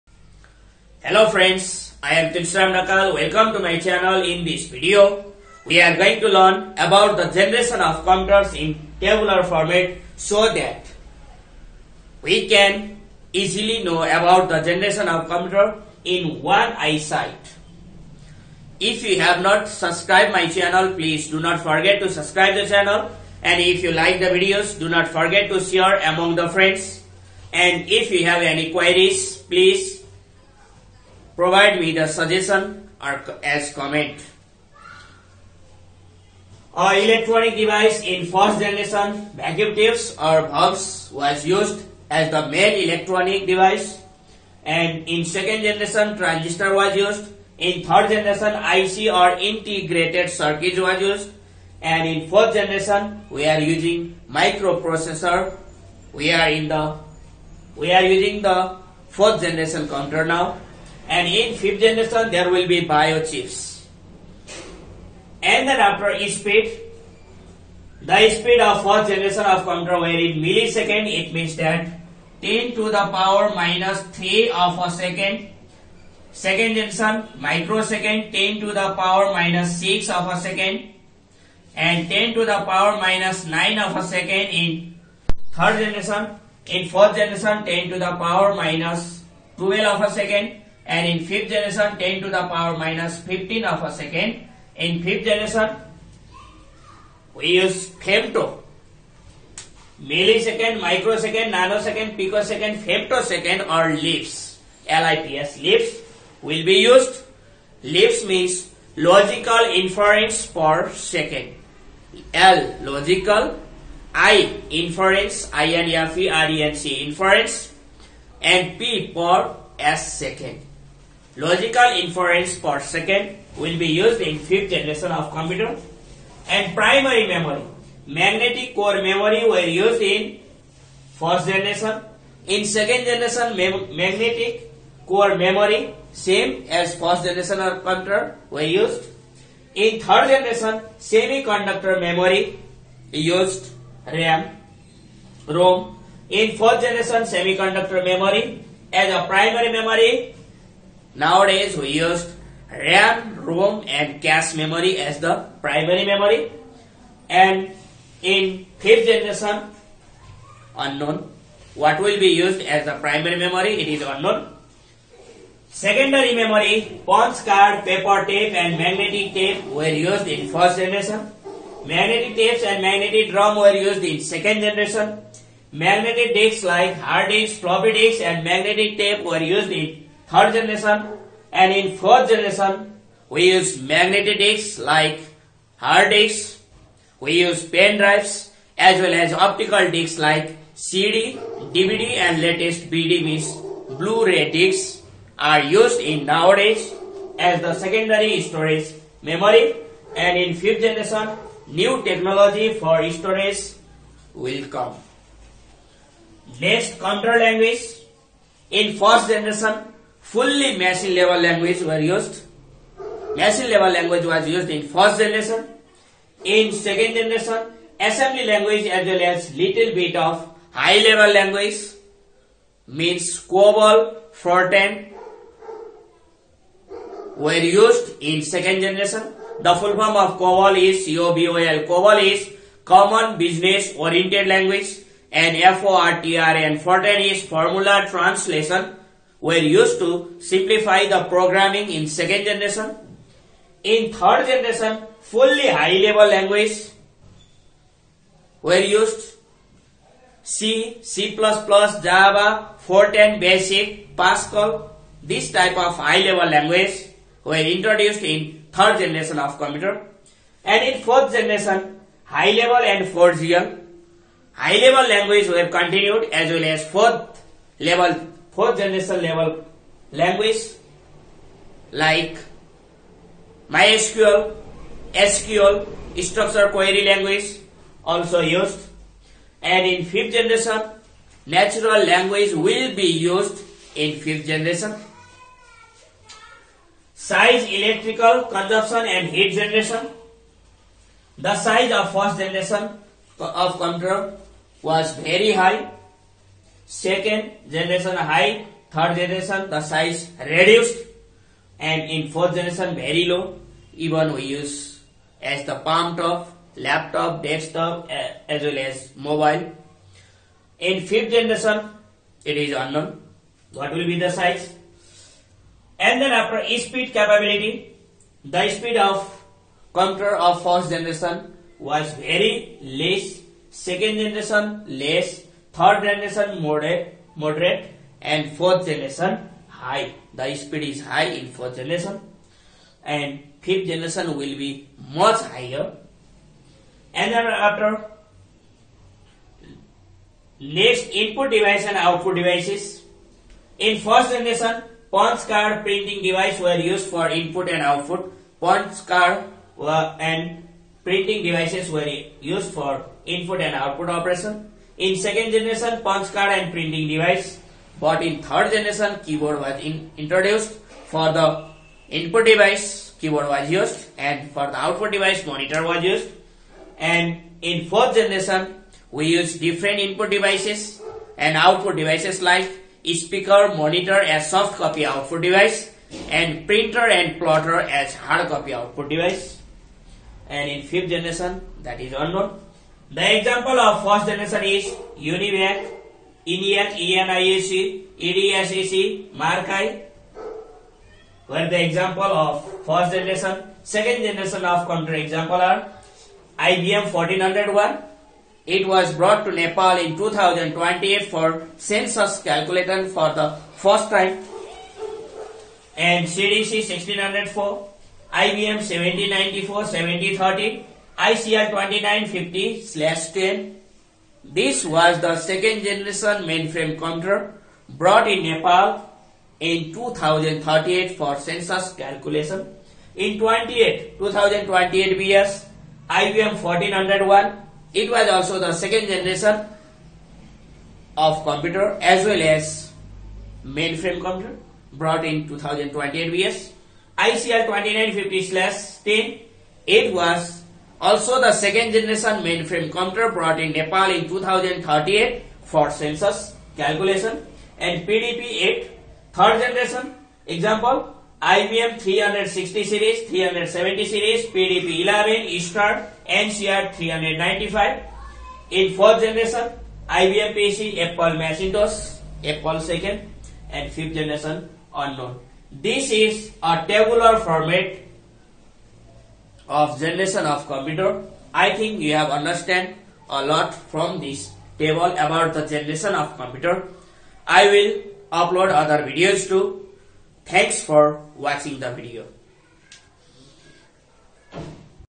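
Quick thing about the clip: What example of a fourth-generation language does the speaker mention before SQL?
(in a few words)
MySQL.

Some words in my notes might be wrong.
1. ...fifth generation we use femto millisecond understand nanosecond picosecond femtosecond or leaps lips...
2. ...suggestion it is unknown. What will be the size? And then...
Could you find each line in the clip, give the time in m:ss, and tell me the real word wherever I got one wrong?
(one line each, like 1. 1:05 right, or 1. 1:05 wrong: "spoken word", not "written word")
1. 1:35 wrong: "microsecond", not "understand"
2. 5:11 wrong: "generation", not "suggestion".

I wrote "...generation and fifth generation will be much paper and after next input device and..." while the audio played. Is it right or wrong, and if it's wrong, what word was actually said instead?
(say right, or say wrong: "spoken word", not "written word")
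wrong: "higher", not "paper".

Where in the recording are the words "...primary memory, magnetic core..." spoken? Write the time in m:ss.
2:06.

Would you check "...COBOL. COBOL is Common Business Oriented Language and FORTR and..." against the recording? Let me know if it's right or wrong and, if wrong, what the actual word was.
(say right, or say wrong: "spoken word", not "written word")
right.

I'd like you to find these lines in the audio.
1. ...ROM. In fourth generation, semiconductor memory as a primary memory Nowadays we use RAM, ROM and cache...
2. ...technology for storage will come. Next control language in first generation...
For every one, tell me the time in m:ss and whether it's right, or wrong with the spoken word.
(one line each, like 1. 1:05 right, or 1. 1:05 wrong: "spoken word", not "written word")
1. 2:25 right
2. 3:22 right.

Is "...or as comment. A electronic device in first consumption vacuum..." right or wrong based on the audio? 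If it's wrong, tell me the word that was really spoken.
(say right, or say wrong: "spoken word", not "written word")
wrong: "generation", not "consumption".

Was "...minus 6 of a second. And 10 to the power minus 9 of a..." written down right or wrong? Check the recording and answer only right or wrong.
right.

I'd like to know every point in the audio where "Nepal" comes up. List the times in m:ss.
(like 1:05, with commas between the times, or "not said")
6:39, 6:58, 7:23.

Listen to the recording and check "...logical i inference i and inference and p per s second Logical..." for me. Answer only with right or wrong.
right.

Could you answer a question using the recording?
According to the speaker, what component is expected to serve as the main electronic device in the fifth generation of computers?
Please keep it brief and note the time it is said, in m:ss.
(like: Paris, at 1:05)
Biochips, at 1:02.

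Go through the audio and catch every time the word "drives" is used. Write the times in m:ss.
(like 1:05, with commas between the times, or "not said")
3:07.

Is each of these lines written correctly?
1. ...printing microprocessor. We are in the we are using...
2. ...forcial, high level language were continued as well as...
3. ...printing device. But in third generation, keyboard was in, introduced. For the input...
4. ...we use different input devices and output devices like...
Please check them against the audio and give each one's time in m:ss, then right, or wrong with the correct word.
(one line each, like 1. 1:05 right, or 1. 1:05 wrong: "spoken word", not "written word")
1. 0:53 wrong: "using", not "printing"
2. 4:23 right
3. 5:56 right
4. 6:09 right.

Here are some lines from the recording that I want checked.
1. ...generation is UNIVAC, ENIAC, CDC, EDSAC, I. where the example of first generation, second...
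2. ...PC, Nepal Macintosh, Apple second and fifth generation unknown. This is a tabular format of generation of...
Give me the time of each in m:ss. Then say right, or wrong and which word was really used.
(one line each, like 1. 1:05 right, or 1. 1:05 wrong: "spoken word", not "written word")
1. 6:24 wrong: "ENIAC", not "CDC"
2. 7:40 wrong: "Apple", not "Nepal".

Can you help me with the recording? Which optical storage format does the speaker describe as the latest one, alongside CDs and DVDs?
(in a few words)
Blu-ray disks.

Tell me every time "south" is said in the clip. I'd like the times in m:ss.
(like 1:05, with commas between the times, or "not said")
not said.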